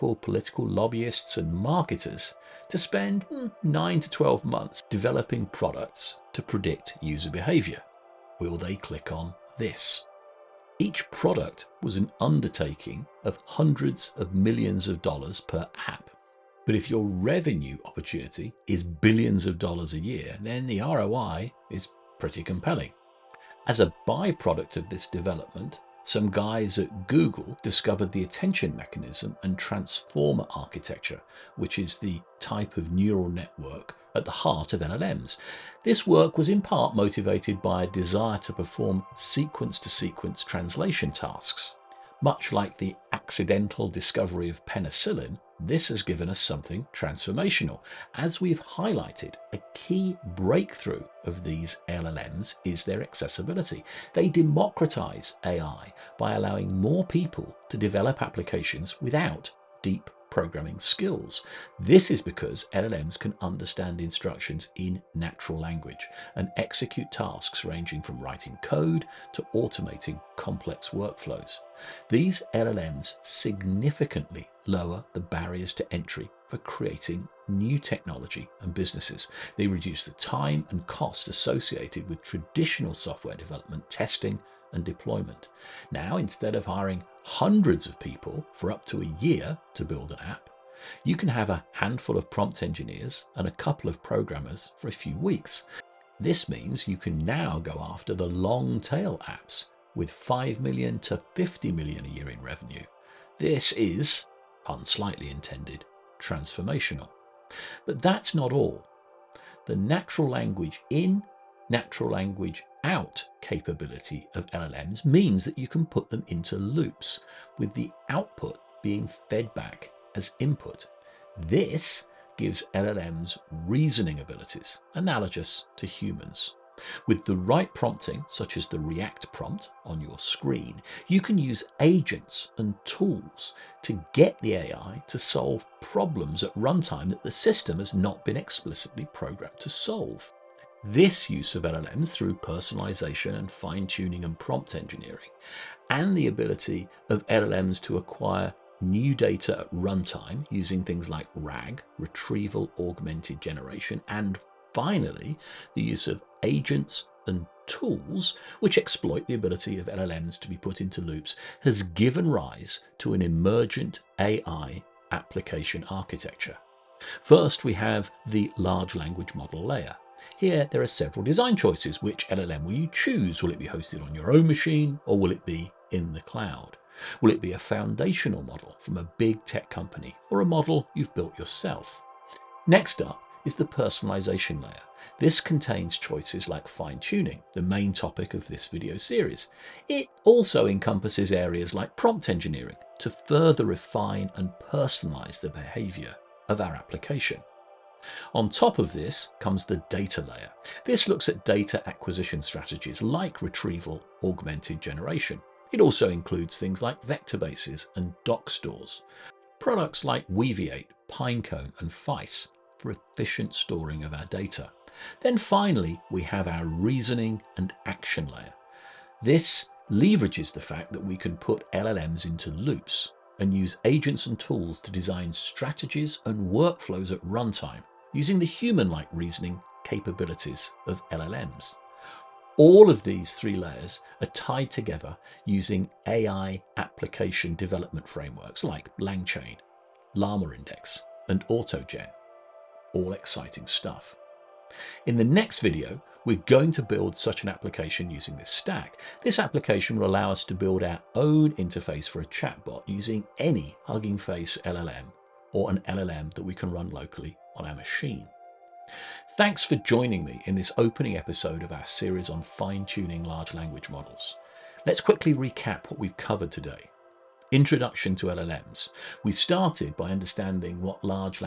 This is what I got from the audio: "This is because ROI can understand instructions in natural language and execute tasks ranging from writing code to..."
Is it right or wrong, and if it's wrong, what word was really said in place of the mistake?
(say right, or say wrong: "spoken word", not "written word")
wrong: "LLMs", not "ROI".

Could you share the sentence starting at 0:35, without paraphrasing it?
This work was in part motivated by a desire to perform sequence to sequence translation tasks.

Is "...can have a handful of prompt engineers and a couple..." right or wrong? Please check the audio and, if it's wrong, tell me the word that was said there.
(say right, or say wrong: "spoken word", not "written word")
right.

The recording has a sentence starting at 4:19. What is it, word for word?
Thanks for joining me in this opening episode of our series on fine tuning large language models.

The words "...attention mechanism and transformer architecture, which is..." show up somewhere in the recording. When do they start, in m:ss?
0:28.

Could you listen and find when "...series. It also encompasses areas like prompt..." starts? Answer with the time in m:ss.
3:08.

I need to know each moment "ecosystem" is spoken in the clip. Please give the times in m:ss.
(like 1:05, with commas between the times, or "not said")
not said.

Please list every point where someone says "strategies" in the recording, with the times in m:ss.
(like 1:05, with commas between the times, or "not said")
3:22, 3:45.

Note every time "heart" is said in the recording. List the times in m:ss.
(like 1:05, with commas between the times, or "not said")
0:34.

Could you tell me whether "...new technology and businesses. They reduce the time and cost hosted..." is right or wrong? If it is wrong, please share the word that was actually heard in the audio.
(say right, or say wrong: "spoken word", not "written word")
wrong: "associated", not "hosted".